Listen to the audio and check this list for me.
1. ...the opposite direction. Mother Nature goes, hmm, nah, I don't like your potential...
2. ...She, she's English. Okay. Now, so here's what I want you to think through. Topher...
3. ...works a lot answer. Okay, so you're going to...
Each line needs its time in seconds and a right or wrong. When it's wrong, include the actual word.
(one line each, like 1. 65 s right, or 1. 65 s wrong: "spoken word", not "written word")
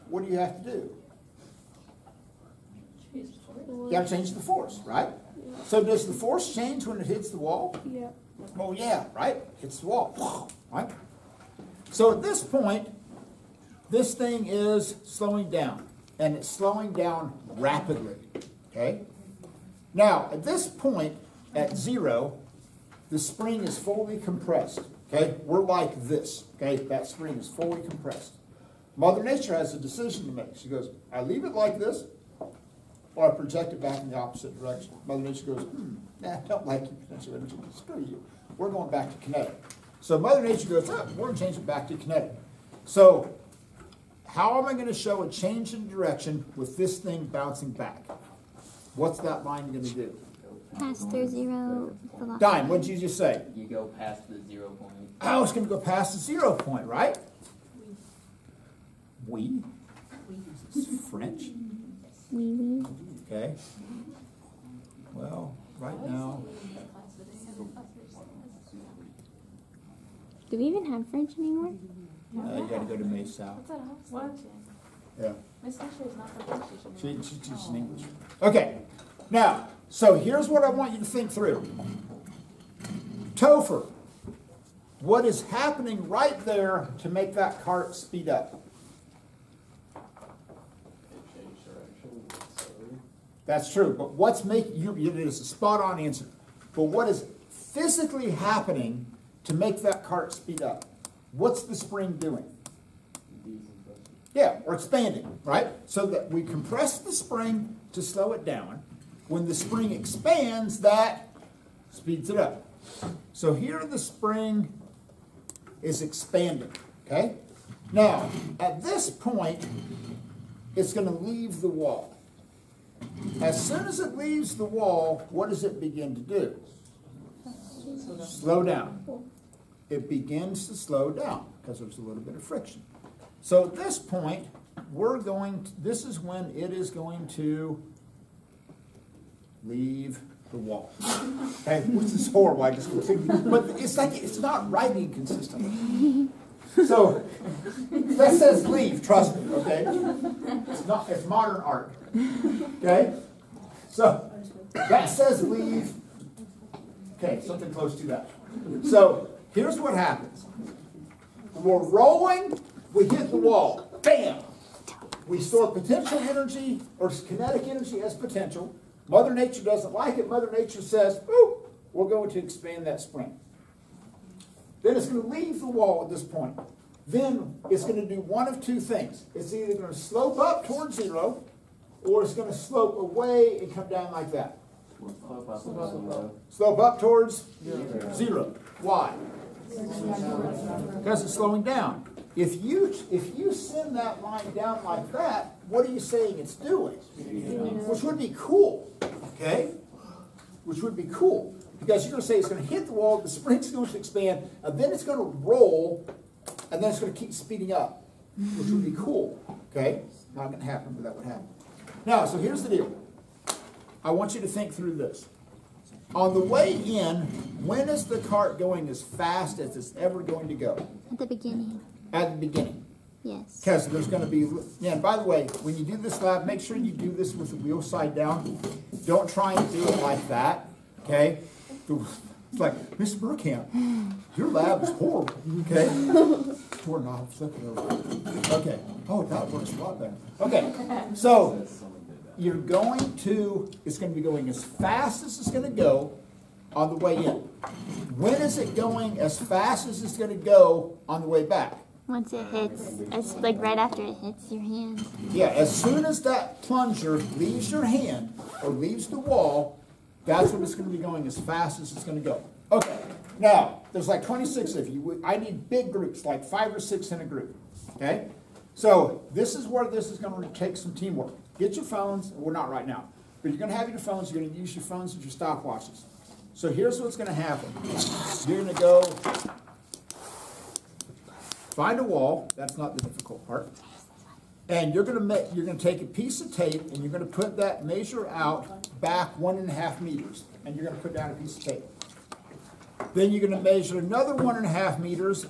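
1. 34 s right
2. 77 s right
3. 239 s wrong: "better", not "answer".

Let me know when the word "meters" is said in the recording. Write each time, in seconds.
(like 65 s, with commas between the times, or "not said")
290 s, 294 s.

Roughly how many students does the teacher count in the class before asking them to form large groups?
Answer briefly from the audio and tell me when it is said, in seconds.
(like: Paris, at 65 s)
26, at 264 s.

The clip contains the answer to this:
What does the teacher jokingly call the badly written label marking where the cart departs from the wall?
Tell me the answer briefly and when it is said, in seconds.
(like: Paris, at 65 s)
modern art, at 151 s.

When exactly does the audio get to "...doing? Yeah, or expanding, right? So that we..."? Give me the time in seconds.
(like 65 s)
102 s.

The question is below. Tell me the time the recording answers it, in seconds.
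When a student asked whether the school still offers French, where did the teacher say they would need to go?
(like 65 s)
73 s.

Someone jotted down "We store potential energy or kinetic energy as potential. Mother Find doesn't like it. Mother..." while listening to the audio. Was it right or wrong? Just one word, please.
wrong.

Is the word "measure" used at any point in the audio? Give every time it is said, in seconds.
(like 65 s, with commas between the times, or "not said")
287 s, 293 s.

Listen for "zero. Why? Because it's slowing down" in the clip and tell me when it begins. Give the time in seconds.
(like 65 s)
188 s.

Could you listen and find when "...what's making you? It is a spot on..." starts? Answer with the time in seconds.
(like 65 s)
94 s.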